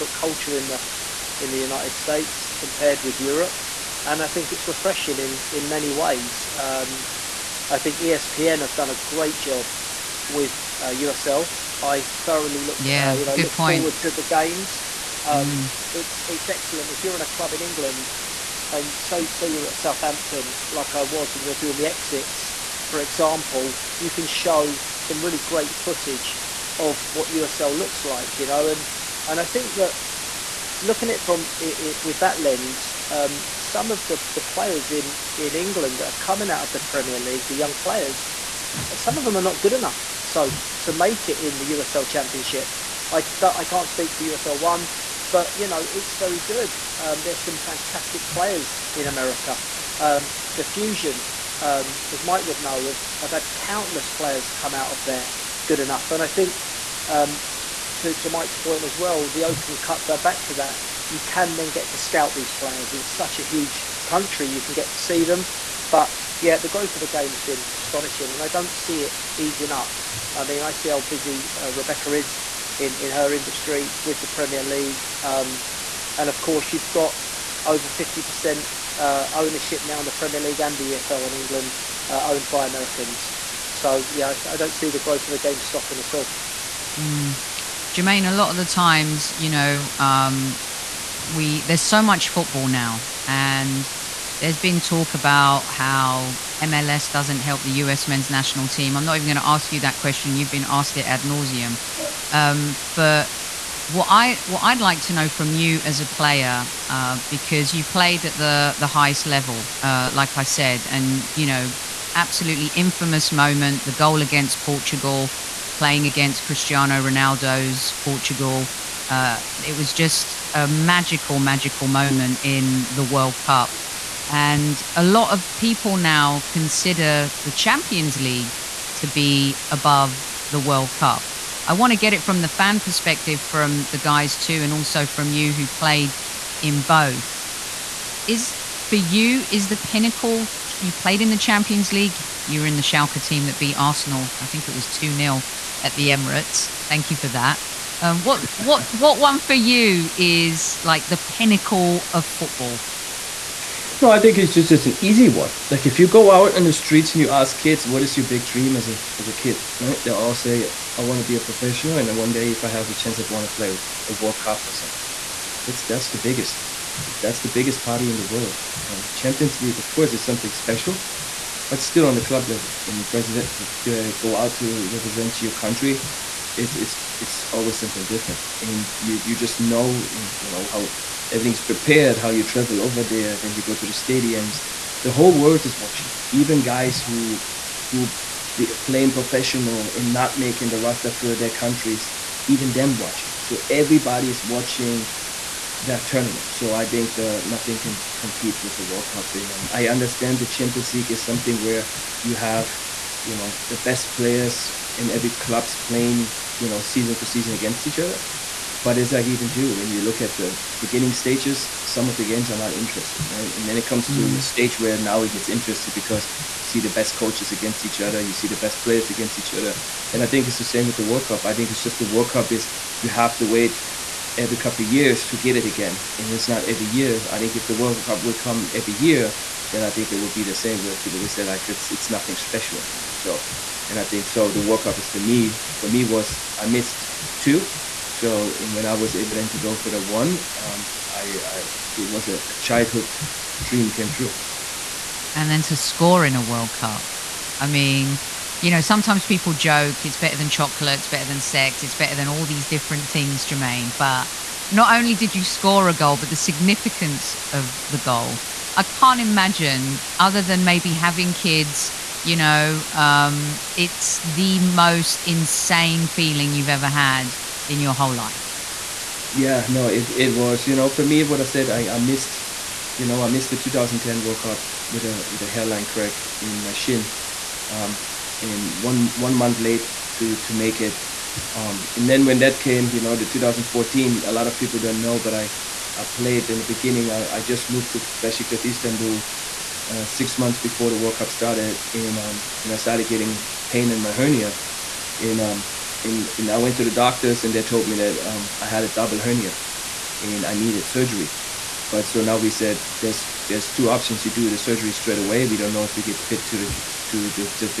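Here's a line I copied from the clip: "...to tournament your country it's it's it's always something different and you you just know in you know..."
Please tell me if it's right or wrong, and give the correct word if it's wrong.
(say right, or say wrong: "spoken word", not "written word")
wrong: "represent", not "tournament".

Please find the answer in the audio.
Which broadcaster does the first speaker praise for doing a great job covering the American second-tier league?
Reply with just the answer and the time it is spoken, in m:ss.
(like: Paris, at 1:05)
ESPN, at 0:08.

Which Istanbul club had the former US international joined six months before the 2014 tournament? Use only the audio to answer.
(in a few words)
Besiktas.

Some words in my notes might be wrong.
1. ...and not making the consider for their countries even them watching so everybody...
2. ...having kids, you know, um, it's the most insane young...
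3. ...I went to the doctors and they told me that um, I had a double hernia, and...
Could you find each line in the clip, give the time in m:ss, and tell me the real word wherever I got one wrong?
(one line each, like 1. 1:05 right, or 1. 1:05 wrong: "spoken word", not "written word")
1. 3:09 wrong: "roster", not "consider"
2. 4:20 wrong: "feeling", not "young"
3. 4:56 right.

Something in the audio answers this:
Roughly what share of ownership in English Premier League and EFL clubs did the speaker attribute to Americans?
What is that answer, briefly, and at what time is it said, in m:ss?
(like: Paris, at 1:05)
over 50%, at 1:17.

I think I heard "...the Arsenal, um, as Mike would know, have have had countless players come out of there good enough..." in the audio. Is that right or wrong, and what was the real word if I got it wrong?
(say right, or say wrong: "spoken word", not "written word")
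wrong: "Fusion", not "Arsenal".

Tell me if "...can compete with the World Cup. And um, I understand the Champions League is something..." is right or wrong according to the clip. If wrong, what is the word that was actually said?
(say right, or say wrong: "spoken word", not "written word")
right.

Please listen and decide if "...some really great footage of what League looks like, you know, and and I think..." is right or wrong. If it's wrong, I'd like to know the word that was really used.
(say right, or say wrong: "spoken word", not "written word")
wrong: "USL", not "League".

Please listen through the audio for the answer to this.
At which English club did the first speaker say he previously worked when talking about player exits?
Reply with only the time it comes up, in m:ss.
0:19.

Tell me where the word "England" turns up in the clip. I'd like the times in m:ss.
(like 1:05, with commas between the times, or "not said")
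0:17, 0:35, 1:21.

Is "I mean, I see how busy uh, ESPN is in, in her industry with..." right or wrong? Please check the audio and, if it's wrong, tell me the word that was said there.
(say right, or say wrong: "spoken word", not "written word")
wrong: "Rebecca", not "ESPN".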